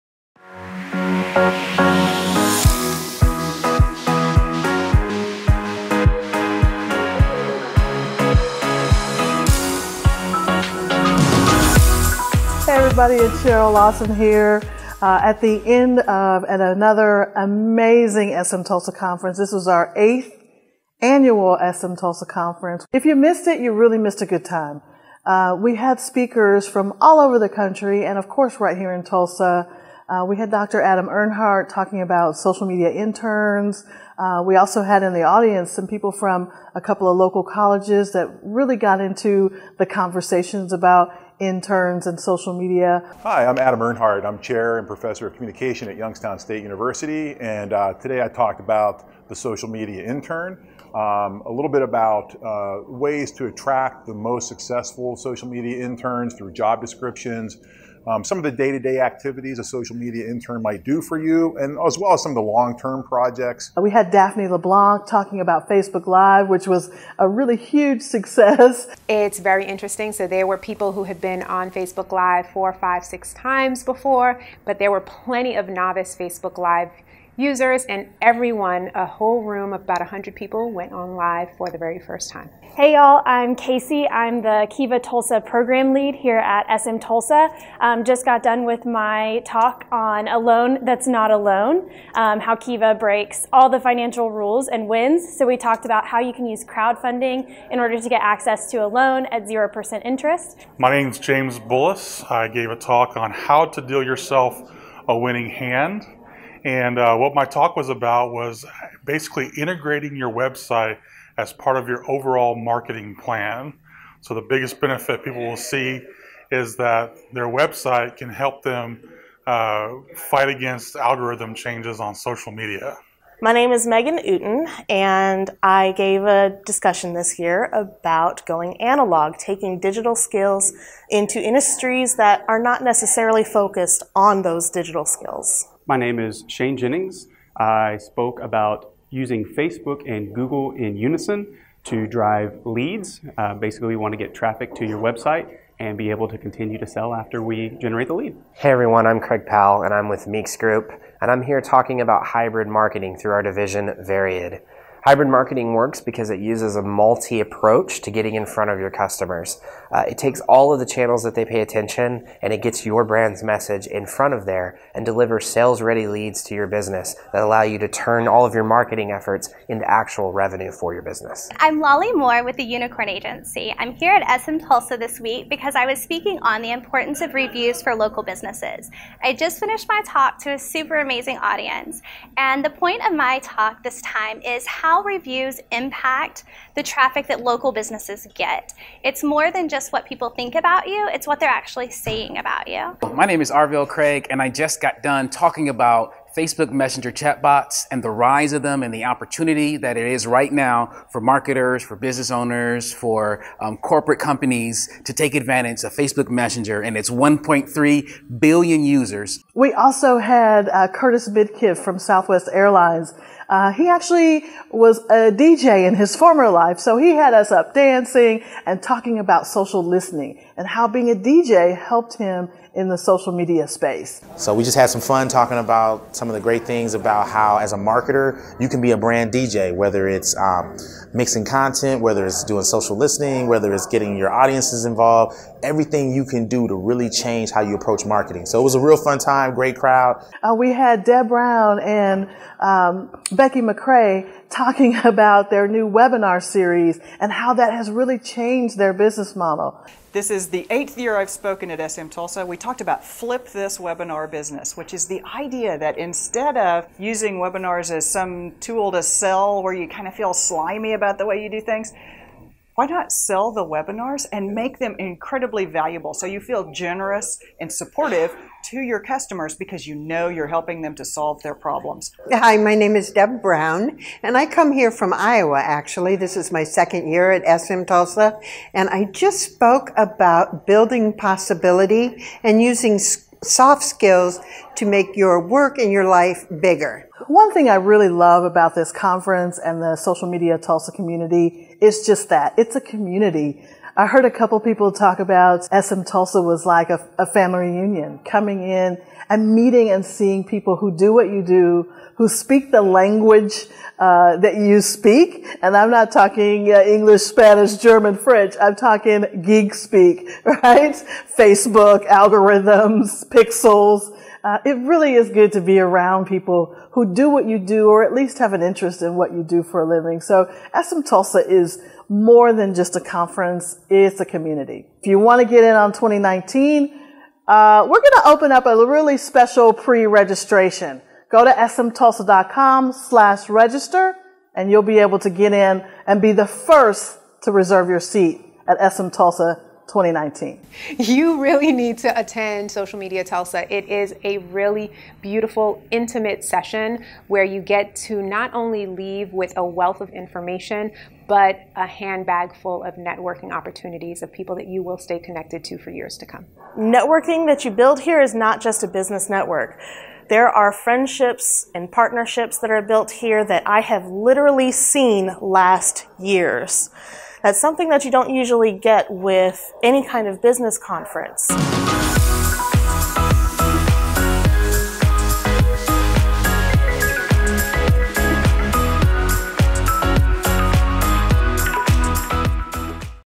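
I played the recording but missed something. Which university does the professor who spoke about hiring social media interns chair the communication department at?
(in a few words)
Youngstown State University.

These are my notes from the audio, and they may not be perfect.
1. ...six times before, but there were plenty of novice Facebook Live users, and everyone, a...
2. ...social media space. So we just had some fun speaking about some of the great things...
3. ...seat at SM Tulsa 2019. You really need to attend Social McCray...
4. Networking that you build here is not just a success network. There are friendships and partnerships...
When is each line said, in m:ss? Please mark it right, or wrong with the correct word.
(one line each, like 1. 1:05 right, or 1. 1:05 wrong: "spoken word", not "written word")
1. 1:13 right
2. 3:42 wrong: "talking", not "speaking"
3. 5:38 wrong: "Media", not "McCray"
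4. 5:56 wrong: "business", not "success".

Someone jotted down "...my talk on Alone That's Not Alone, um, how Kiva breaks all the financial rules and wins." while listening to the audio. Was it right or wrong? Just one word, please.
right.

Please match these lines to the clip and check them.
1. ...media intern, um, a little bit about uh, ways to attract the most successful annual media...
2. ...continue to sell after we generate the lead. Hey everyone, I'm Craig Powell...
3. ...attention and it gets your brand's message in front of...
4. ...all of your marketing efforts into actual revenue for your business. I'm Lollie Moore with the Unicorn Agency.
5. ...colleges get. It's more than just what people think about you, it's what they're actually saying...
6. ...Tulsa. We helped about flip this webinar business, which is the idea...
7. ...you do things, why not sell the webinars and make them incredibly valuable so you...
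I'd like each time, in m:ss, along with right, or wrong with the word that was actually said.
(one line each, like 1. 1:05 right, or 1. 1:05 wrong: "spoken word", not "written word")
1. 0:49 wrong: "social", not "annual"
2. 2:26 right
3. 2:41 right
4. 2:48 right
5. 3:07 wrong: "businesses", not "colleges"
6. 4:12 wrong: "talked", not "helped"
7. 4:21 right.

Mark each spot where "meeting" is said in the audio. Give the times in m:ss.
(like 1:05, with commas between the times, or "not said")
4:59.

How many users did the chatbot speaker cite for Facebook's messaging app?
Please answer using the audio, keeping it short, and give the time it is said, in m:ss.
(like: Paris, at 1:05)
1.3 billion, at 3:27.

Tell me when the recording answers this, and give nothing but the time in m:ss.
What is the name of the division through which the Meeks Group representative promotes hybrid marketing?
2:34.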